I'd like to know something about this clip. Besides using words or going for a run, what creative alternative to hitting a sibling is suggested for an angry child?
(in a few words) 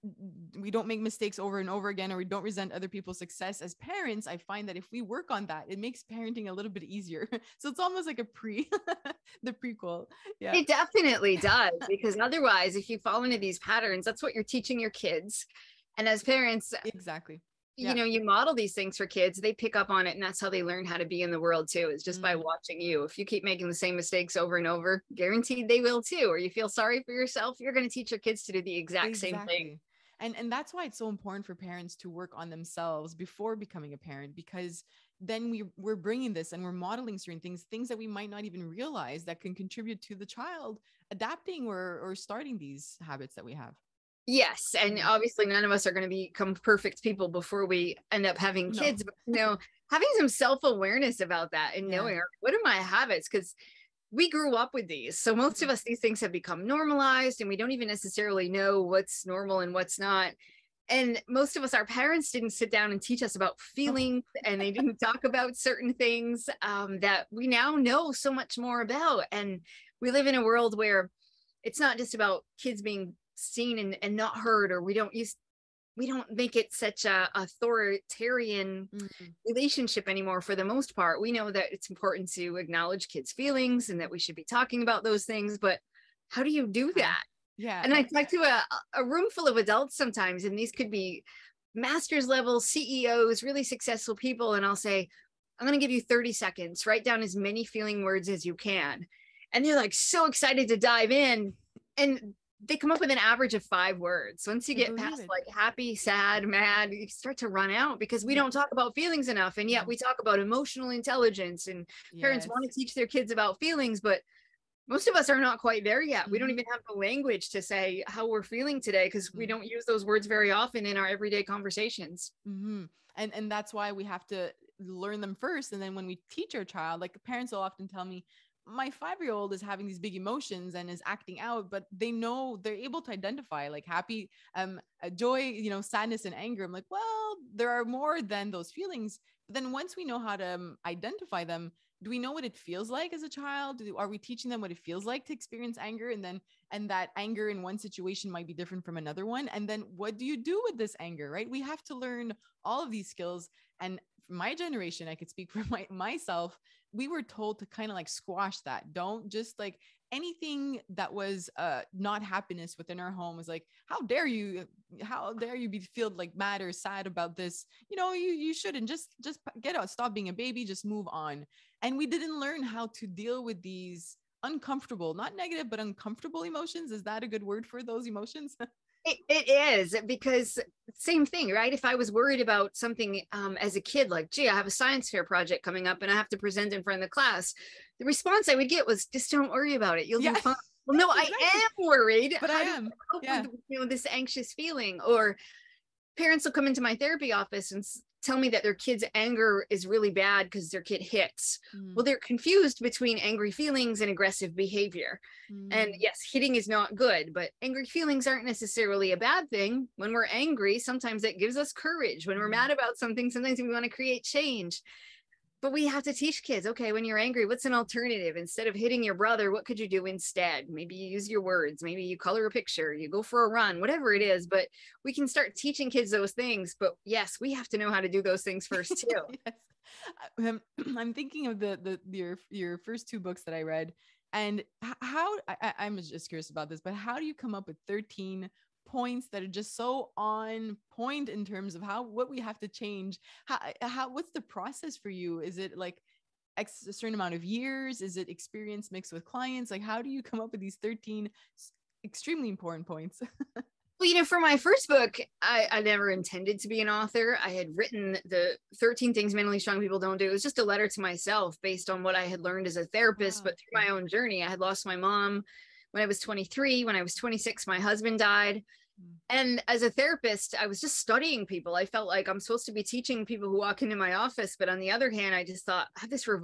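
color a picture.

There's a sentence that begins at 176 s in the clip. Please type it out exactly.
Is that a good word for those emotions?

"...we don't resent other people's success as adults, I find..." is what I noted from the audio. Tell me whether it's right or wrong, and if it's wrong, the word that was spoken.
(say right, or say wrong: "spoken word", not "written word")
wrong: "parents", not "adults".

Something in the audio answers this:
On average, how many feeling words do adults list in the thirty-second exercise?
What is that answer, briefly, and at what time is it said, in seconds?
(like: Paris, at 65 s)
5 words, at 103 s.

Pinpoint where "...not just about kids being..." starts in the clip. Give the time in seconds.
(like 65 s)
71 s.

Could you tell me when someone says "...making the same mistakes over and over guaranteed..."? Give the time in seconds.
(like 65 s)
23 s.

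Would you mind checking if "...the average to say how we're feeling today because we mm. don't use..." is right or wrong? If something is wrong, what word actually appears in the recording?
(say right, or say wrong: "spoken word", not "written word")
wrong: "language", not "average".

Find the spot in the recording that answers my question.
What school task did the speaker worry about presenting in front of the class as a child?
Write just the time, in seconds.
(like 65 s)
184 s.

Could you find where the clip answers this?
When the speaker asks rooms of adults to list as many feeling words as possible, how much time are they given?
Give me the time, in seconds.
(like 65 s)
96 s.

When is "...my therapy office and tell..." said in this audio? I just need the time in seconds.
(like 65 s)
196 s.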